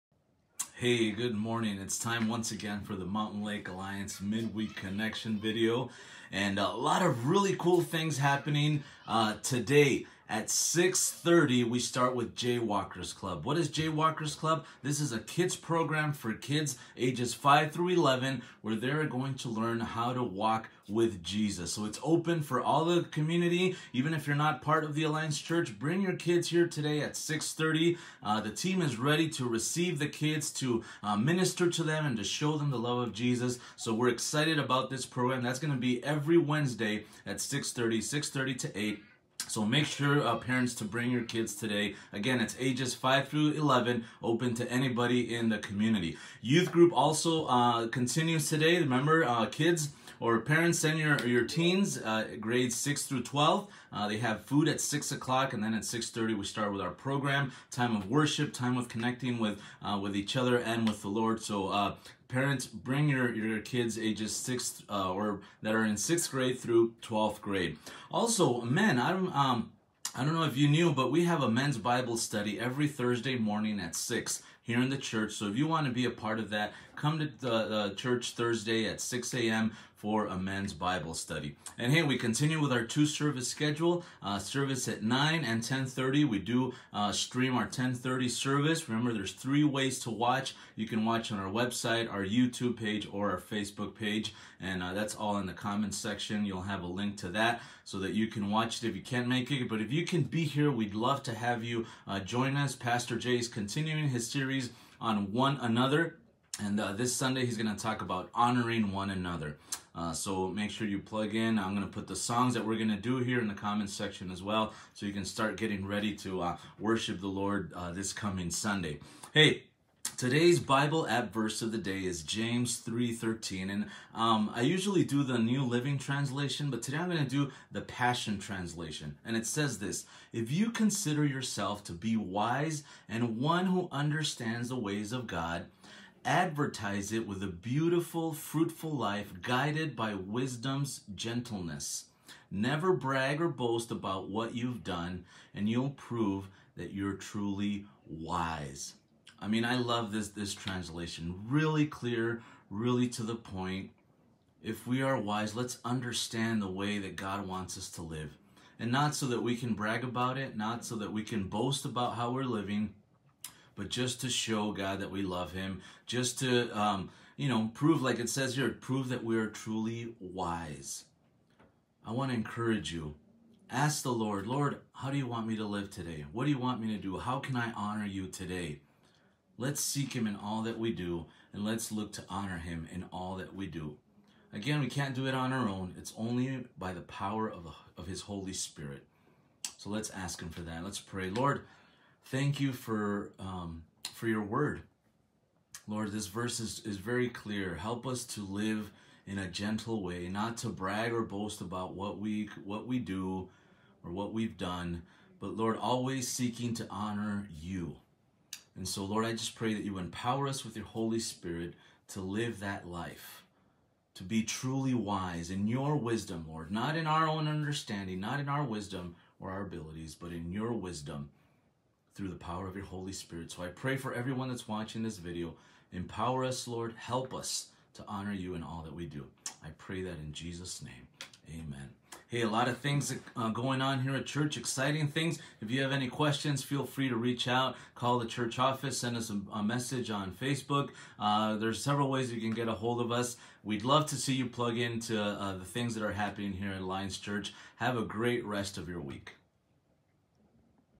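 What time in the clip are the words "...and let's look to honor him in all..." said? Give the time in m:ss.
3:01.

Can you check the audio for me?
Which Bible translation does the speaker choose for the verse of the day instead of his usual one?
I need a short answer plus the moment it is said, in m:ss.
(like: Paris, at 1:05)
Passion Translation, at 2:07.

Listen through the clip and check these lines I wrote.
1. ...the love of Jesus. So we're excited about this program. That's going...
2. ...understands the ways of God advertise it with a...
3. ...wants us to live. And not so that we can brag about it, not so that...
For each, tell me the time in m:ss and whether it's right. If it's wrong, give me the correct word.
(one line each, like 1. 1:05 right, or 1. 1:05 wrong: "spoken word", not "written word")
1. 0:32 right
2. 2:13 right
3. 2:37 right.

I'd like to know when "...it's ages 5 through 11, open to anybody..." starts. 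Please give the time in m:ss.
0:42.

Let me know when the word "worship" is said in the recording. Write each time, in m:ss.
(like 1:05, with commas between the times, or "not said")
0:58, 1:56.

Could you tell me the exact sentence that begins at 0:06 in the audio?
And a lot of really cool things happening uh, today.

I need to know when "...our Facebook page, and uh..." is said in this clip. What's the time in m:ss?
1:33.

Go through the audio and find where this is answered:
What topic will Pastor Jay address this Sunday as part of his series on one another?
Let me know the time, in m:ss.
1:48.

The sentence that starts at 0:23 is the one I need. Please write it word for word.
Even if you're not part of the Alliance Church, bring your kids here today at 6.30.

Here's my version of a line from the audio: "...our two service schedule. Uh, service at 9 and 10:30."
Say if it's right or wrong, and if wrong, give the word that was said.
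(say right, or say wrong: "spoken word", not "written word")
right.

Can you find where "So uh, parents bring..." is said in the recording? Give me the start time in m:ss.
1:01.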